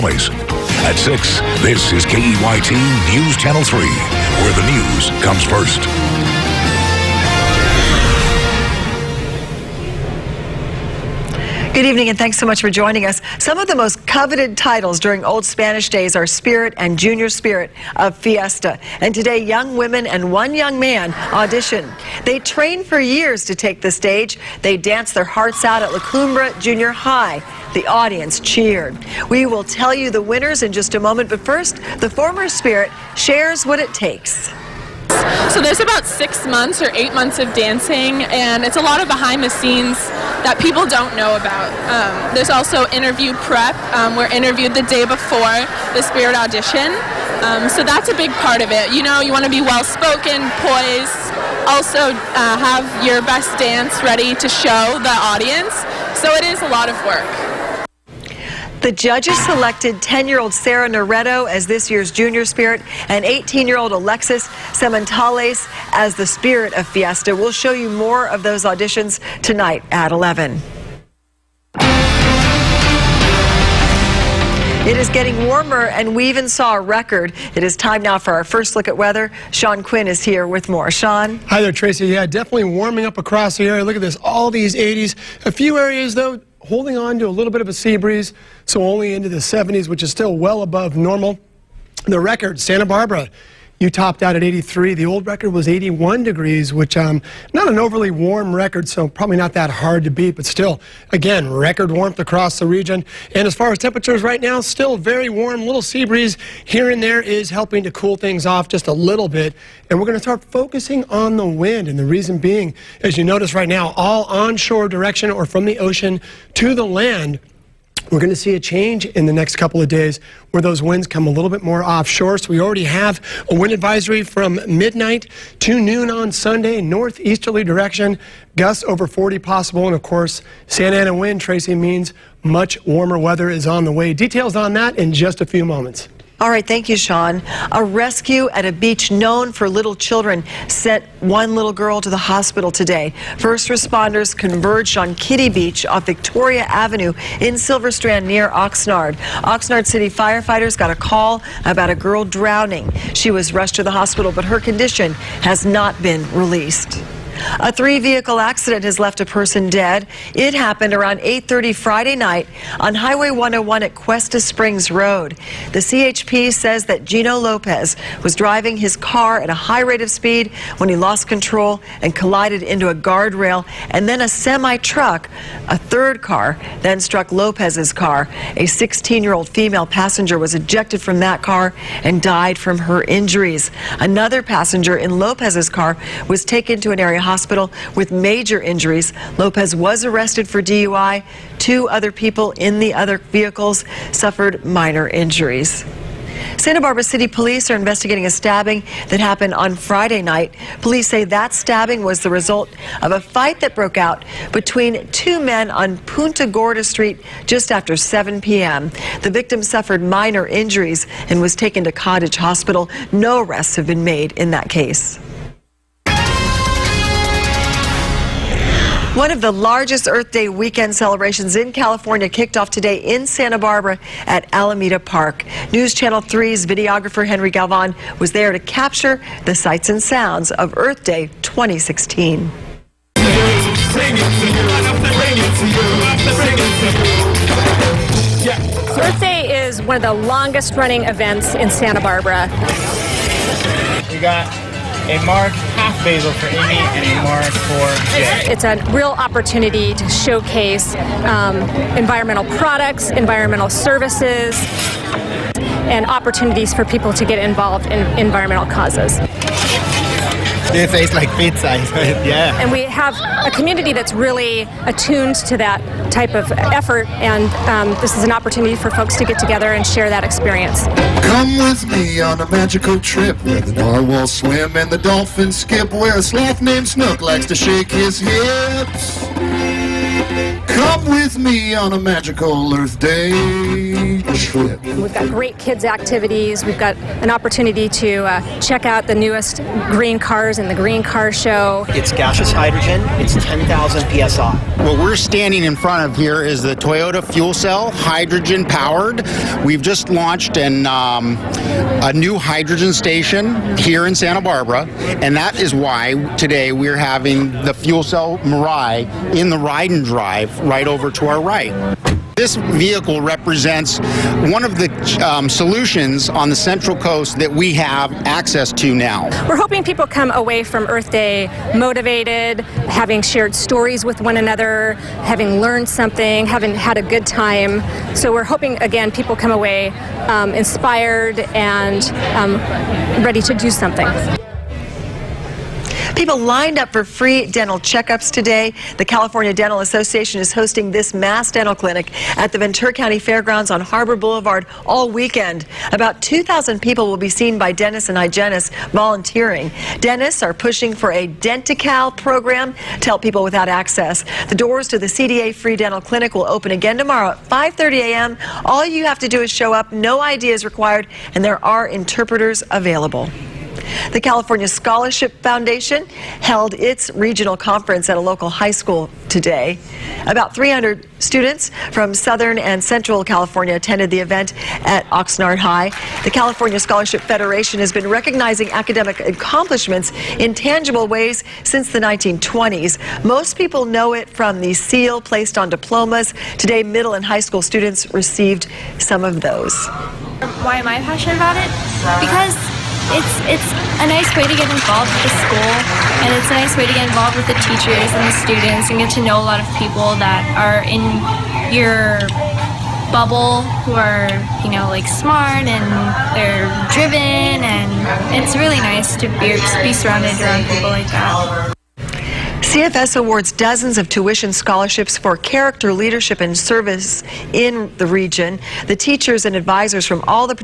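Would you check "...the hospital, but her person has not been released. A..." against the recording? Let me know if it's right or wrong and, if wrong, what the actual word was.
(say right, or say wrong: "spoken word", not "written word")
wrong: "condition", not "person".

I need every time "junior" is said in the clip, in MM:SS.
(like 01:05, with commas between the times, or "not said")
00:16, 00:26, 01:02.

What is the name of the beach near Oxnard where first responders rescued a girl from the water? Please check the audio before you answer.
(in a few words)
Kiddie Beach.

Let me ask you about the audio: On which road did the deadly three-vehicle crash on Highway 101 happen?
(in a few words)
Cuesta Springs Road.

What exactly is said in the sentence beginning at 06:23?
Most people know it from the seal placed on diplomas.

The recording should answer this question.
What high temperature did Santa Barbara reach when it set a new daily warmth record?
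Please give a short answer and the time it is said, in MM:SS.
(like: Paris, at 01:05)
83, at 01:34.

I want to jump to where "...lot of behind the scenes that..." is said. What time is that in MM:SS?
00:38.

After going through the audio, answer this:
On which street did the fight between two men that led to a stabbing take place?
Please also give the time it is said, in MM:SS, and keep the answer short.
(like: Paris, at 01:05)
Punta Gorda Street, at 03:25.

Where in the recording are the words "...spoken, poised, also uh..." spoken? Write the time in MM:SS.
00:49.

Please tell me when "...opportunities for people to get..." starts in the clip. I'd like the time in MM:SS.
04:16.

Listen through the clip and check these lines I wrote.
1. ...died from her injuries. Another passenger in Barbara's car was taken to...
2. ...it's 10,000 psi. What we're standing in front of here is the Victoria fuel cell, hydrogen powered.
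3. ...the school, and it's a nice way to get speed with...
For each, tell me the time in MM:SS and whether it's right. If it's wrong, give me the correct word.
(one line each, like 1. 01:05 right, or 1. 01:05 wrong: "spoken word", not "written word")
1. 03:02 wrong: "Lopez", not "Barbara"
2. 04:53 wrong: "Toyota", not "Victoria"
3. 06:35 wrong: "involved", not "speed".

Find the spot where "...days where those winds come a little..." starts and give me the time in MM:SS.
01:59.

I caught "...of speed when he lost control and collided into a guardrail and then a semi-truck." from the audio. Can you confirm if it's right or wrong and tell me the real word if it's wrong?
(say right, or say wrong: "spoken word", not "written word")
right.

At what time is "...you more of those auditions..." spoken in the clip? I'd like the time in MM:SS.
01:07.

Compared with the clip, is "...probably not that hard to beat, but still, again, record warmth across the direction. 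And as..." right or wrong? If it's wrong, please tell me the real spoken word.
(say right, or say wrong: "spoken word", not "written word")
wrong: "region", not "direction".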